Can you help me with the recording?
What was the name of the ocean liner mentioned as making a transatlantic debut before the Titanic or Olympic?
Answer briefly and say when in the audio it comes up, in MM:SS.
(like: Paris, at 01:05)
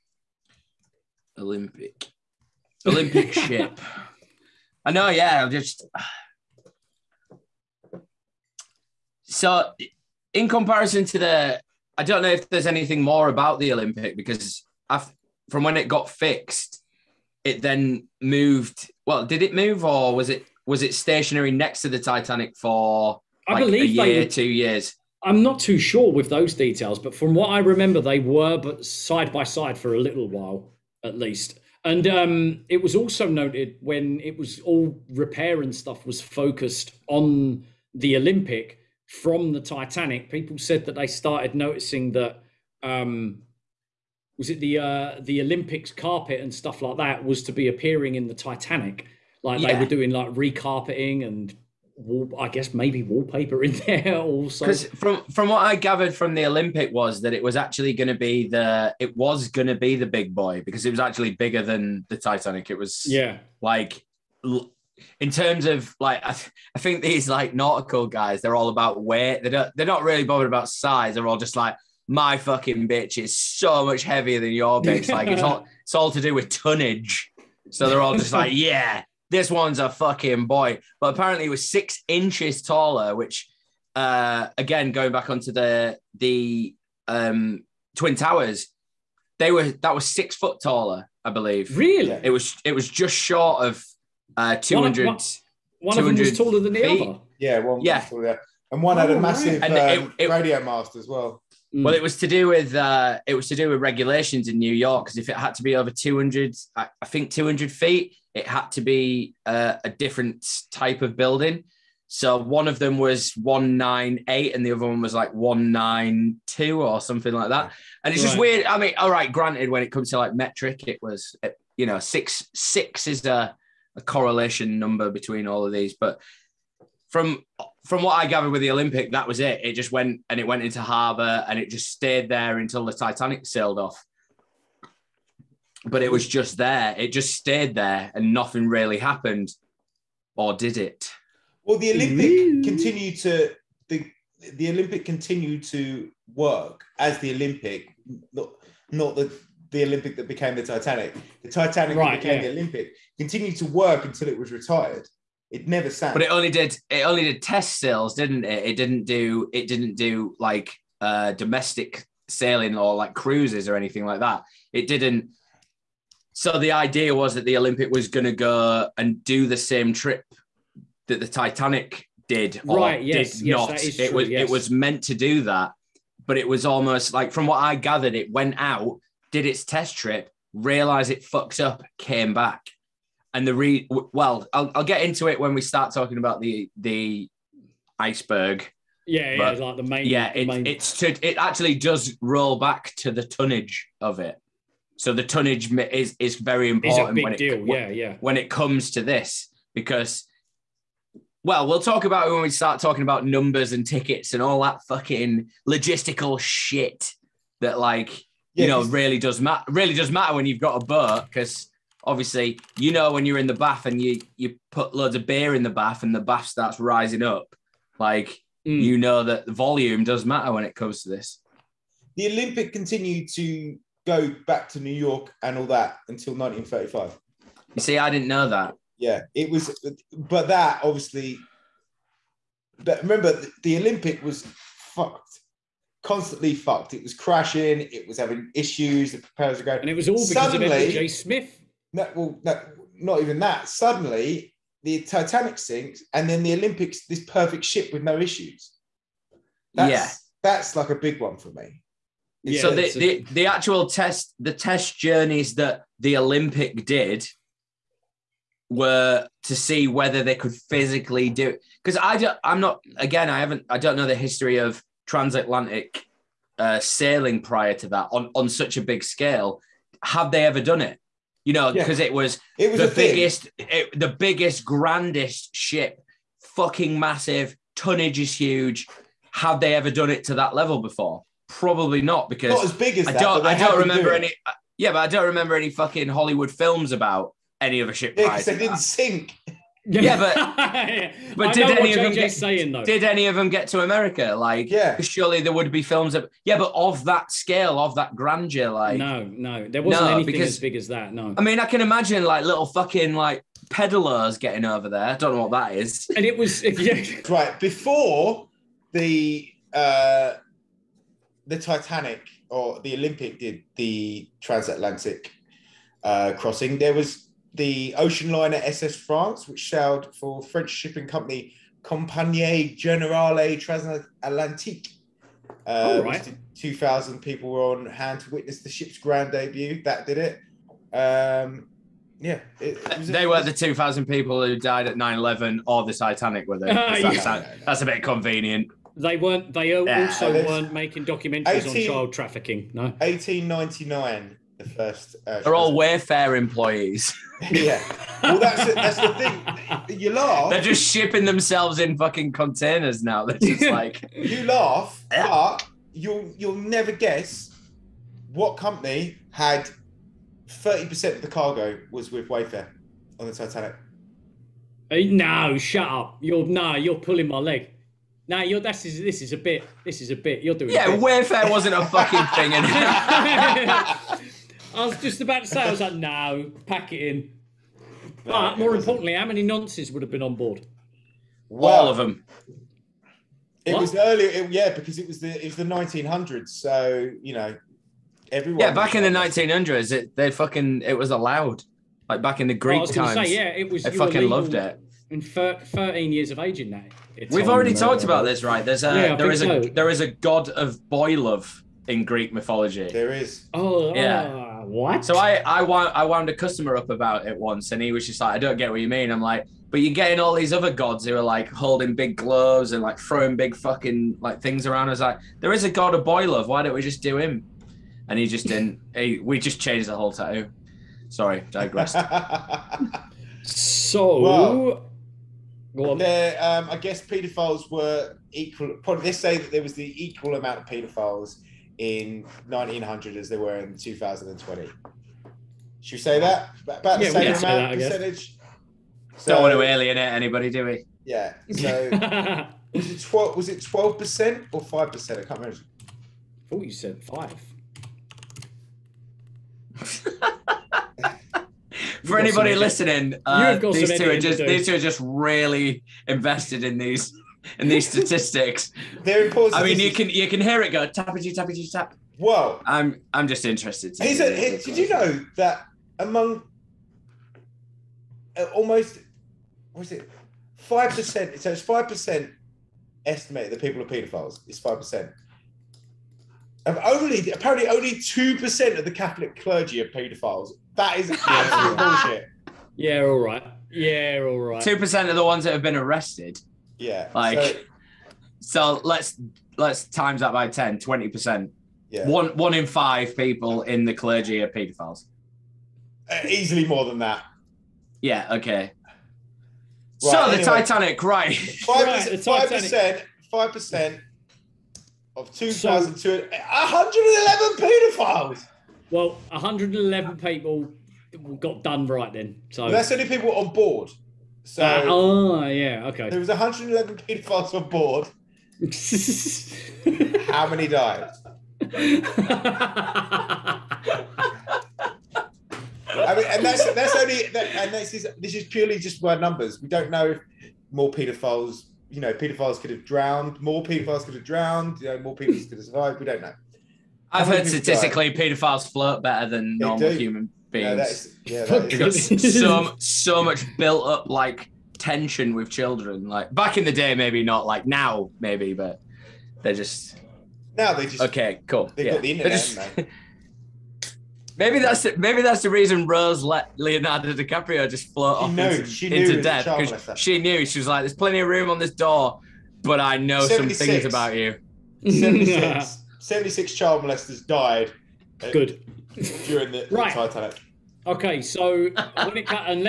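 SS France, at 05:18.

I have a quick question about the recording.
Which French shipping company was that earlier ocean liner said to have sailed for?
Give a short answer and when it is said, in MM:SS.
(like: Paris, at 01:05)
Compagnie Generale Transatlantique, at 05:21.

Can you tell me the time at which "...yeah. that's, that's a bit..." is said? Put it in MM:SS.
05:36.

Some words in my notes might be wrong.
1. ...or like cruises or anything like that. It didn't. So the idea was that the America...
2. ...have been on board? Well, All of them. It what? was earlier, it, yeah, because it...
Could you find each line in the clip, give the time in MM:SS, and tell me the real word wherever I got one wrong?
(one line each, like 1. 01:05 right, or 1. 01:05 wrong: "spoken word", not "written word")
1. 02:42 wrong: "Olympic", not "America"
2. 06:20 right.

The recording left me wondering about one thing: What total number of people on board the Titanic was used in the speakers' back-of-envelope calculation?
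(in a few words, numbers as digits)
2,211.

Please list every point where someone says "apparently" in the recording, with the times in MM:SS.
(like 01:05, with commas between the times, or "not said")
01:21, 07:57.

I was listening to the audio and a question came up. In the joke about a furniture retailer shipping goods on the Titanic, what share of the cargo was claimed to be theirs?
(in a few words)
30%.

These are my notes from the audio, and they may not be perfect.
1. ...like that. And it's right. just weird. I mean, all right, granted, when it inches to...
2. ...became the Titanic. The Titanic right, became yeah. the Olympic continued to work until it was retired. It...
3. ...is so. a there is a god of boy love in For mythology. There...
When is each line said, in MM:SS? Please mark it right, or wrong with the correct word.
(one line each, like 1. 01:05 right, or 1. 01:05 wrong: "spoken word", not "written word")
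1. 01:57 wrong: "comes", not "inches"
2. 02:30 right
3. 06:39 wrong: "Greek", not "For".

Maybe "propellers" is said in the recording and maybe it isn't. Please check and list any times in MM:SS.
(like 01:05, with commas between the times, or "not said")
03:59.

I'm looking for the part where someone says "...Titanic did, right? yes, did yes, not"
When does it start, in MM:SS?
02:51.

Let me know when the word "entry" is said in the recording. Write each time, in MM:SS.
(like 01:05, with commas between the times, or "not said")
not said.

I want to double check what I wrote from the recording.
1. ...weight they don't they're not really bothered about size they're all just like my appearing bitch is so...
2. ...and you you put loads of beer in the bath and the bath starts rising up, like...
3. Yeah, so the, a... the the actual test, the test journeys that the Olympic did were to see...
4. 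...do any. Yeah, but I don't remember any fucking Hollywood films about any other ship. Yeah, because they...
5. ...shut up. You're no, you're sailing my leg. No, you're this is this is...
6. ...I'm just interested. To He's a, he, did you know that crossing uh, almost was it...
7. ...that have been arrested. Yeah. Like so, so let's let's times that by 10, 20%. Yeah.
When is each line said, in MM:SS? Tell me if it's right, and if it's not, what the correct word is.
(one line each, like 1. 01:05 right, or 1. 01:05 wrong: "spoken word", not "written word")
1. 01:09 wrong: "fucking", not "appearing"
2. 03:33 right
3. 04:12 right
4. 04:44 right
5. 06:05 wrong: "pulling", not "sailing"
6. 07:43 wrong: "among", not "crossing"
7. 08:05 right.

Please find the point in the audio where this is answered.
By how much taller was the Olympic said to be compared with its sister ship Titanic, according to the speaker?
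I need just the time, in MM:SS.
01:21.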